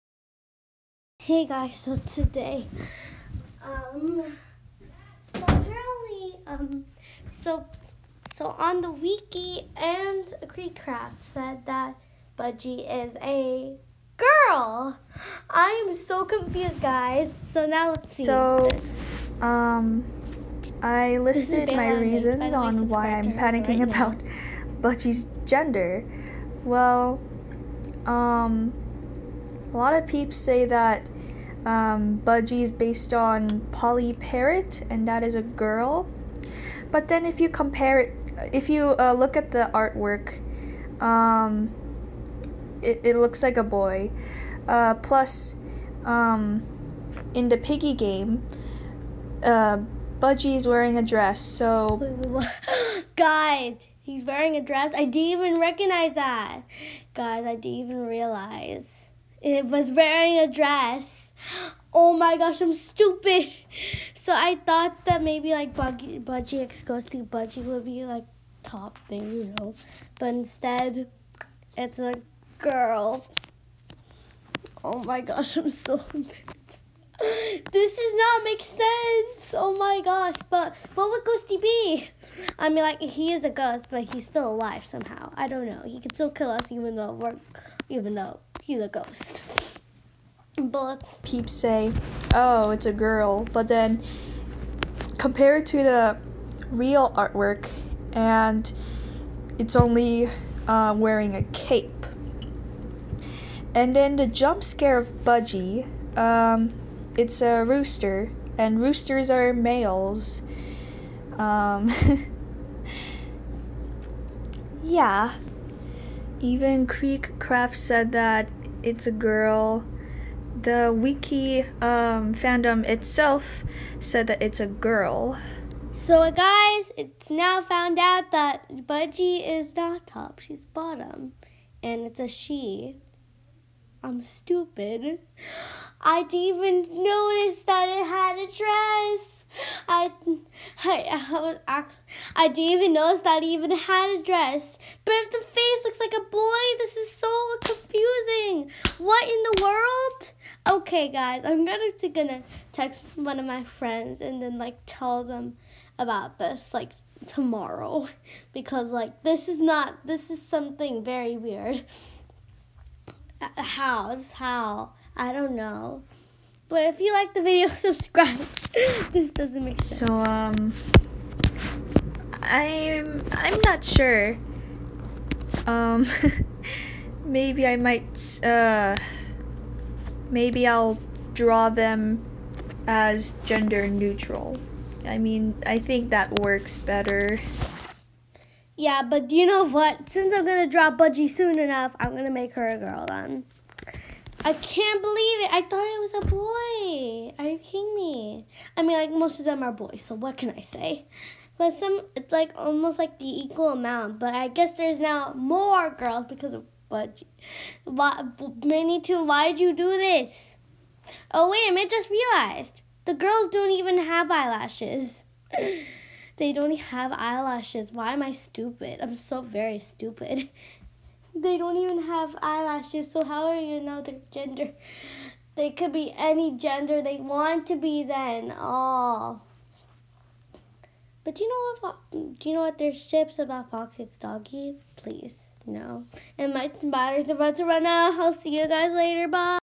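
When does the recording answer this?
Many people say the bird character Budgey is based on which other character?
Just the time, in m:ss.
0:33.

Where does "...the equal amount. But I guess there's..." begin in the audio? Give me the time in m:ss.
3:23.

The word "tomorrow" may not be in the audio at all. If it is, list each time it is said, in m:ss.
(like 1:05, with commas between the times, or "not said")
2:37.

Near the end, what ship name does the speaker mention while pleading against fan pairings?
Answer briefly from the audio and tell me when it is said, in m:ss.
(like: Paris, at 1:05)
Fox Six Doggy, at 3:53.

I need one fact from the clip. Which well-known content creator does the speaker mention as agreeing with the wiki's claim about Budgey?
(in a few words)
KreekCraft.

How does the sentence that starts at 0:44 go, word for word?
Uh, plus, um, in the piggy game, uh, Budgey is wearing a dress, so.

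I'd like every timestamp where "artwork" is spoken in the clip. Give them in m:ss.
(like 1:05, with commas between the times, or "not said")
0:39, 1:37.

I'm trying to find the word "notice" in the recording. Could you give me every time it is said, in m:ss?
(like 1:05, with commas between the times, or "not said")
2:17, 2:22.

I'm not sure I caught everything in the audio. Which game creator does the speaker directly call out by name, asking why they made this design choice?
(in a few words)
MiniToon.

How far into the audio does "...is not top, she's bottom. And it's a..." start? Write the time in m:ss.
2:09.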